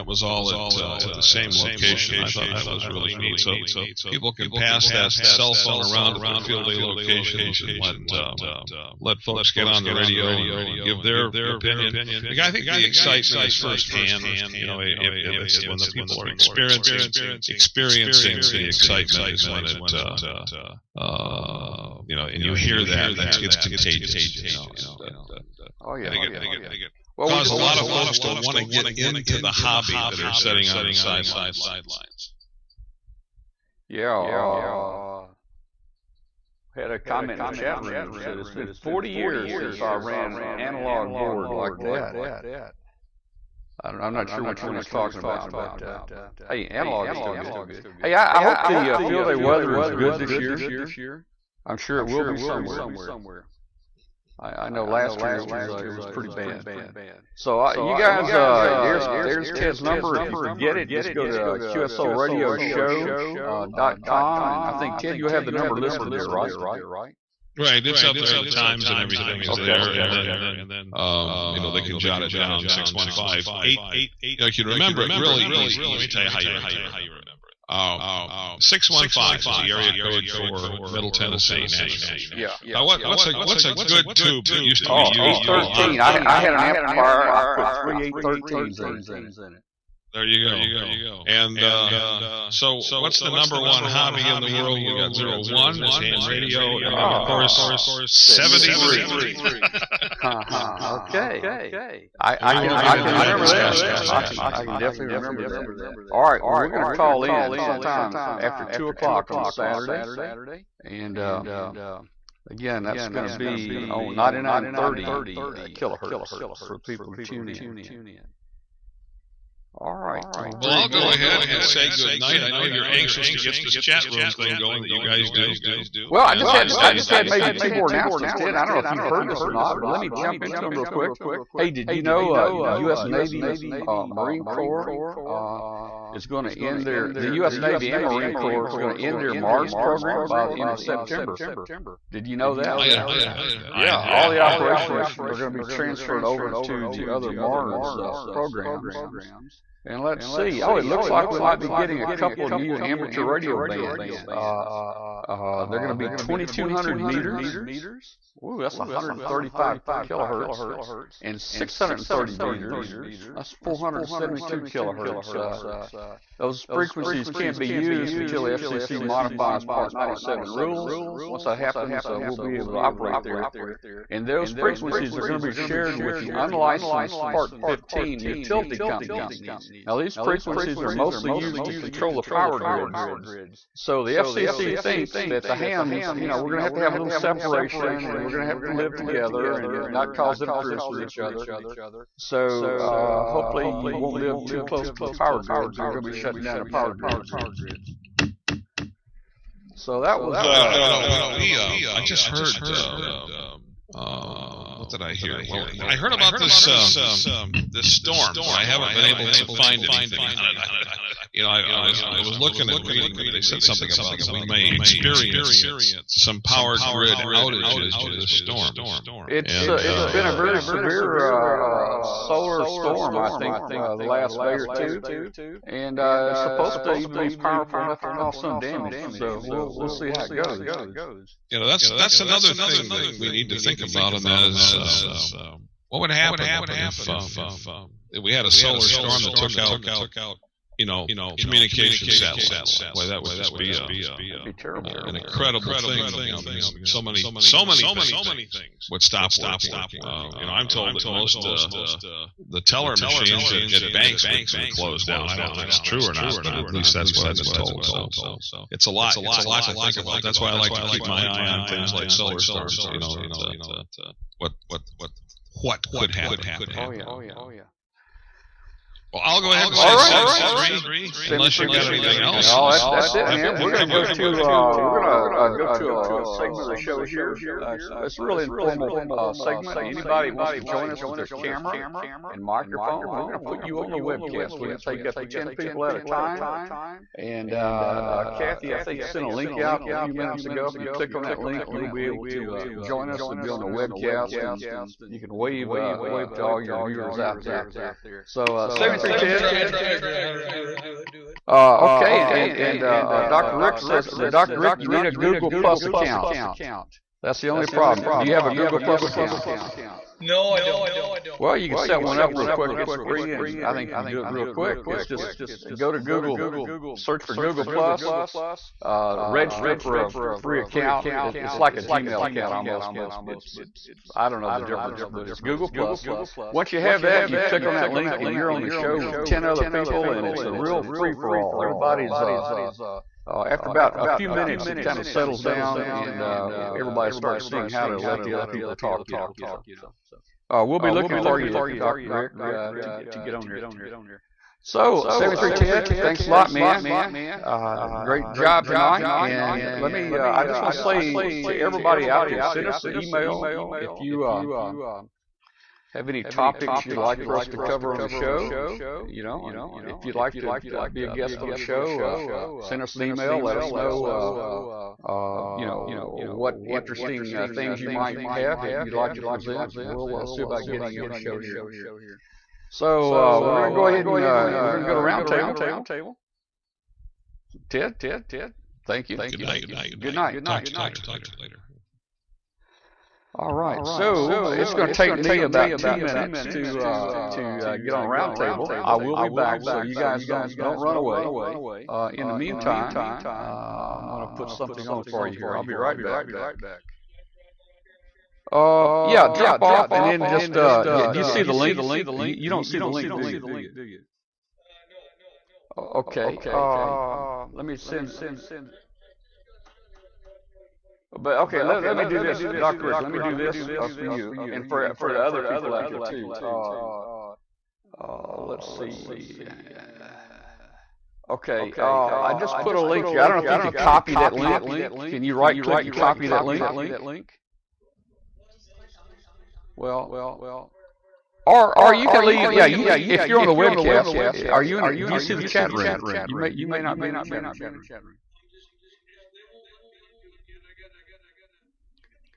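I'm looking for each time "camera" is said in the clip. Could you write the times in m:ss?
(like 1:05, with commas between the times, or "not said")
4:41.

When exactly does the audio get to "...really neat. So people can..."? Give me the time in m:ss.
0:02.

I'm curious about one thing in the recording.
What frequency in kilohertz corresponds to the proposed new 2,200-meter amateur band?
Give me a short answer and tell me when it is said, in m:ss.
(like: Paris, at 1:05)
135 kilohertz, at 2:38.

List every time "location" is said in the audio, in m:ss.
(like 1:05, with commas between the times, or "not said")
0:01, 0:06.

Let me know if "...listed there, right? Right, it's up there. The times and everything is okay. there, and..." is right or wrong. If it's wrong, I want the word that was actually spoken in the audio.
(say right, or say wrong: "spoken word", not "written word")
right.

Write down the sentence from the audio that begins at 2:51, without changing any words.
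Once that happens, uh, we'll be able to operate there.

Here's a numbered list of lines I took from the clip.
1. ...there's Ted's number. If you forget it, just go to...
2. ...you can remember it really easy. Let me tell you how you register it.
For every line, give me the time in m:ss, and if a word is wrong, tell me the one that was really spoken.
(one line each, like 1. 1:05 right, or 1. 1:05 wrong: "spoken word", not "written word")
1. 0:59 right
2. 1:14 wrong: "remember", not "register".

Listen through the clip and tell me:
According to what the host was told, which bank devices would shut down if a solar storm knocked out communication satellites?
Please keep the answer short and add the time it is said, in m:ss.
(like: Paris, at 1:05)
teller machines, at 4:12.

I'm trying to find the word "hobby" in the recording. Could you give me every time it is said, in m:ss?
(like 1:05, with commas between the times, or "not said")
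0:29, 1:33.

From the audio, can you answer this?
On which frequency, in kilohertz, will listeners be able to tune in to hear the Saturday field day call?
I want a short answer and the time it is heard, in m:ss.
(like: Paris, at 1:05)
9930, at 1:54.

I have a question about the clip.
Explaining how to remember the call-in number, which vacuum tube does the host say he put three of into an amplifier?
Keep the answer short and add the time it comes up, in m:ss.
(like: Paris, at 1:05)
813, at 1:25.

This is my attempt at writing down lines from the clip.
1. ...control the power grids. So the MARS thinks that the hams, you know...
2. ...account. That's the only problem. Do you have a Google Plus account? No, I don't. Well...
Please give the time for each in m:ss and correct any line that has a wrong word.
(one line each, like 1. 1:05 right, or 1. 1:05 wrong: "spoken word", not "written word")
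1. 3:01 wrong: "FCC", not "MARS"
2. 5:05 right.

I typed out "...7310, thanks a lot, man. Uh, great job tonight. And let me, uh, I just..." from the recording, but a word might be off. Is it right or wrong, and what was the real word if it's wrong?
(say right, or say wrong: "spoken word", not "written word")
right.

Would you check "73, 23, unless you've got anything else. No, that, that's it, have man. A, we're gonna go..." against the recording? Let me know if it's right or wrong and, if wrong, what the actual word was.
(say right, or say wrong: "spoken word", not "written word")
wrong: "73", not "23".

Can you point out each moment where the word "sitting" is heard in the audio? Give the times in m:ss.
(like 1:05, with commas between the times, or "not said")
0:30.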